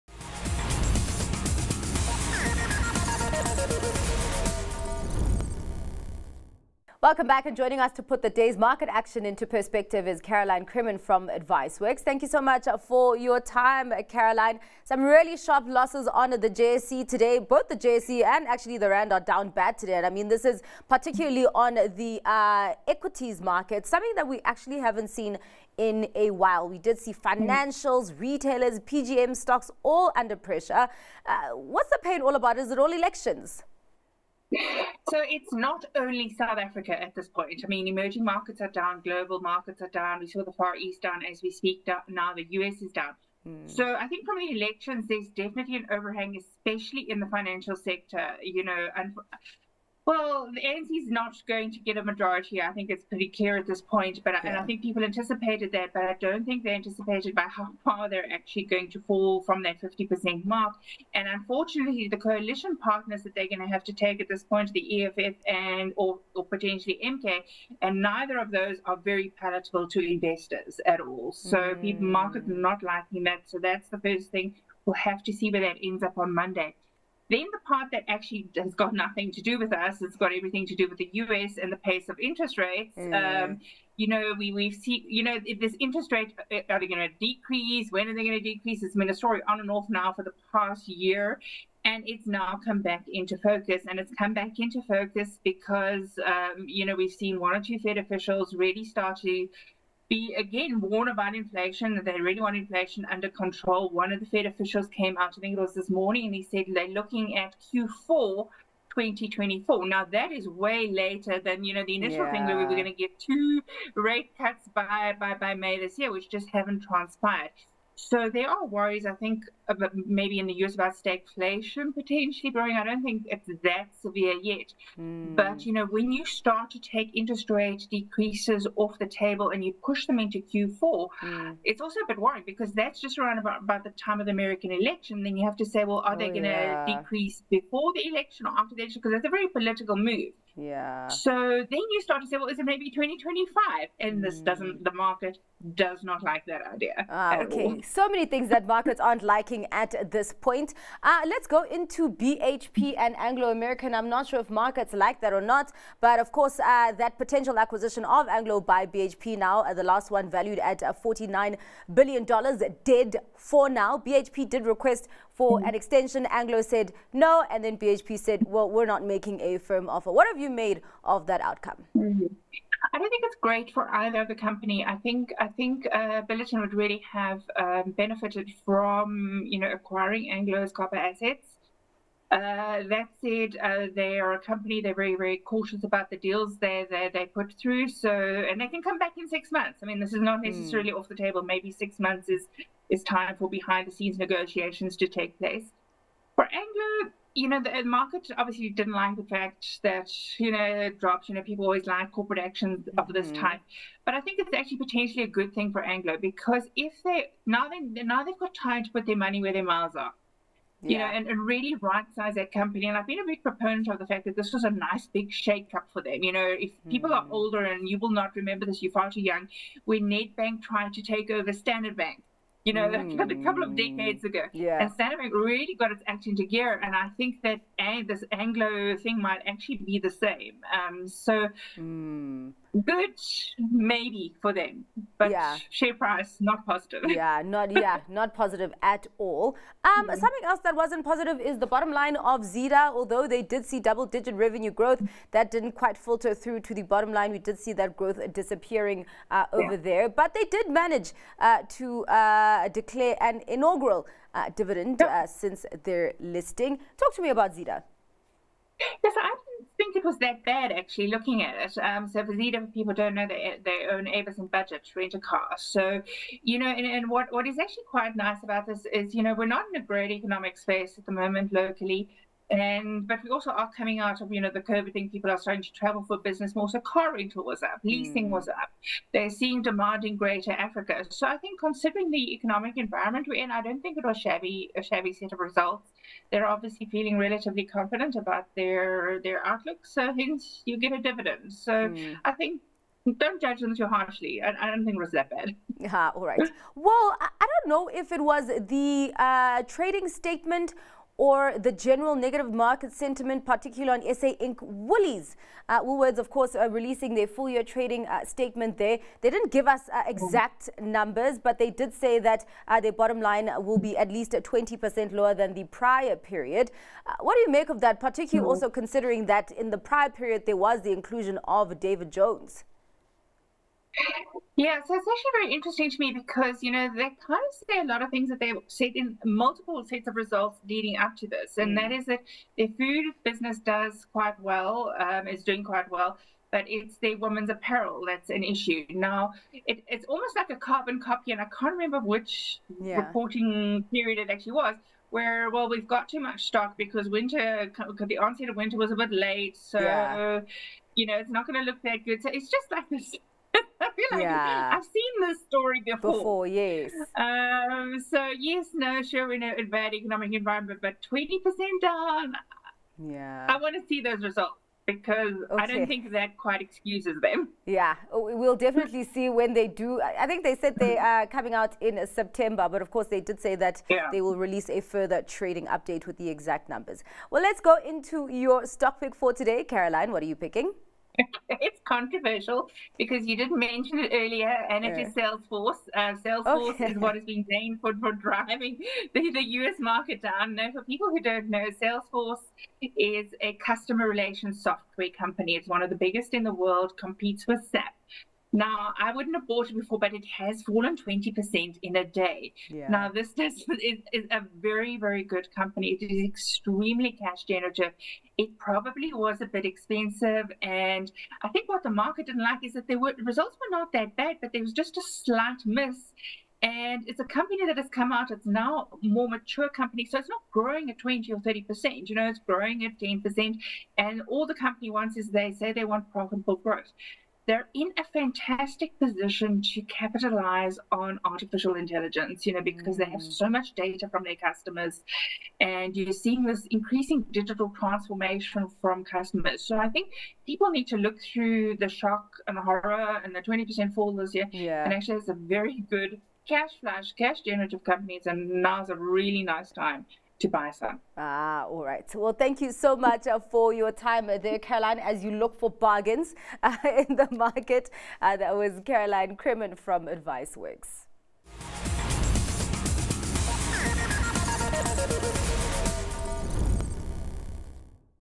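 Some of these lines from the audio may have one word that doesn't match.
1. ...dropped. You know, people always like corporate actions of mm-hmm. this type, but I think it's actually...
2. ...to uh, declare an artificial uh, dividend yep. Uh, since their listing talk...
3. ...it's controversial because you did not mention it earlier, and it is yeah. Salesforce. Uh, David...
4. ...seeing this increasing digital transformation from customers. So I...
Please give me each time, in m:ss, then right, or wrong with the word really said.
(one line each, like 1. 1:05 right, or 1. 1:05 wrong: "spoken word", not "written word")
1. 3:21 right
2. 4:11 wrong: "inaugural", not "artificial"
3. 6:21 wrong: "Salesforce", not "David"
4. 7:16 right.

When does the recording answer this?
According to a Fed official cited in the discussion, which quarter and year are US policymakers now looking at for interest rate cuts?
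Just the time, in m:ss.
1:47.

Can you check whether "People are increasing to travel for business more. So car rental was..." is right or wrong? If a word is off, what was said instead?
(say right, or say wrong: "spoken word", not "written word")
wrong: "starting", not "increasing".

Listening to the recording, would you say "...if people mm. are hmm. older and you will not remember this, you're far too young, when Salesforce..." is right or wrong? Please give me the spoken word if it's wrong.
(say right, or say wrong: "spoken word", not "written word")
wrong: "Bank", not "Salesforce".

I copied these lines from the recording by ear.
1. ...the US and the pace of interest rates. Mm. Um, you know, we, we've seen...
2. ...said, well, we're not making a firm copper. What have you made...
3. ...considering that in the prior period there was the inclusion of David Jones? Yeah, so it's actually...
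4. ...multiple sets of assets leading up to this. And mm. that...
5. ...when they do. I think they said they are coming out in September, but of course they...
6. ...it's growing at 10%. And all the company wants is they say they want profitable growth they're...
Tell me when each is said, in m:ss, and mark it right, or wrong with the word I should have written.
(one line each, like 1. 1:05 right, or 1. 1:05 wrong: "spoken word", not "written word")
1. 1:20 right
2. 2:48 wrong: "offer", not "copper"
3. 5:18 right
4. 5:29 wrong: "results", not "assets"
5. 6:09 right
6. 7:02 right.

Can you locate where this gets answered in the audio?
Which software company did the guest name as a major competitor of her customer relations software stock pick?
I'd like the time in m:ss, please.
6:37.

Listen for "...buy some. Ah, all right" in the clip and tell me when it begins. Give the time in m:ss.
7:30.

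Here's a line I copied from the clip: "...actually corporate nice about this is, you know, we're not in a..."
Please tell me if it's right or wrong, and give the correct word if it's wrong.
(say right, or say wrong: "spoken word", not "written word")
wrong: "quite", not "corporate".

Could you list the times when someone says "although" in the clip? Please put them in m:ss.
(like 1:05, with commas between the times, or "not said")
4:02.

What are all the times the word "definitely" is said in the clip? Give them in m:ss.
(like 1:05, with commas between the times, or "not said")
0:45, 6:08.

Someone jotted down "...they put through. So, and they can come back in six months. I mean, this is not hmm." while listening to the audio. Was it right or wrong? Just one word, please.
right.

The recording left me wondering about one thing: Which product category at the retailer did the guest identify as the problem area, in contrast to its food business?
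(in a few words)
women's apparel.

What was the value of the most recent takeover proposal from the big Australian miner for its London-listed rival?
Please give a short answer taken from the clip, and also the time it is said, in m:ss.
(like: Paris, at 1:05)
$49 billion, at 2:41.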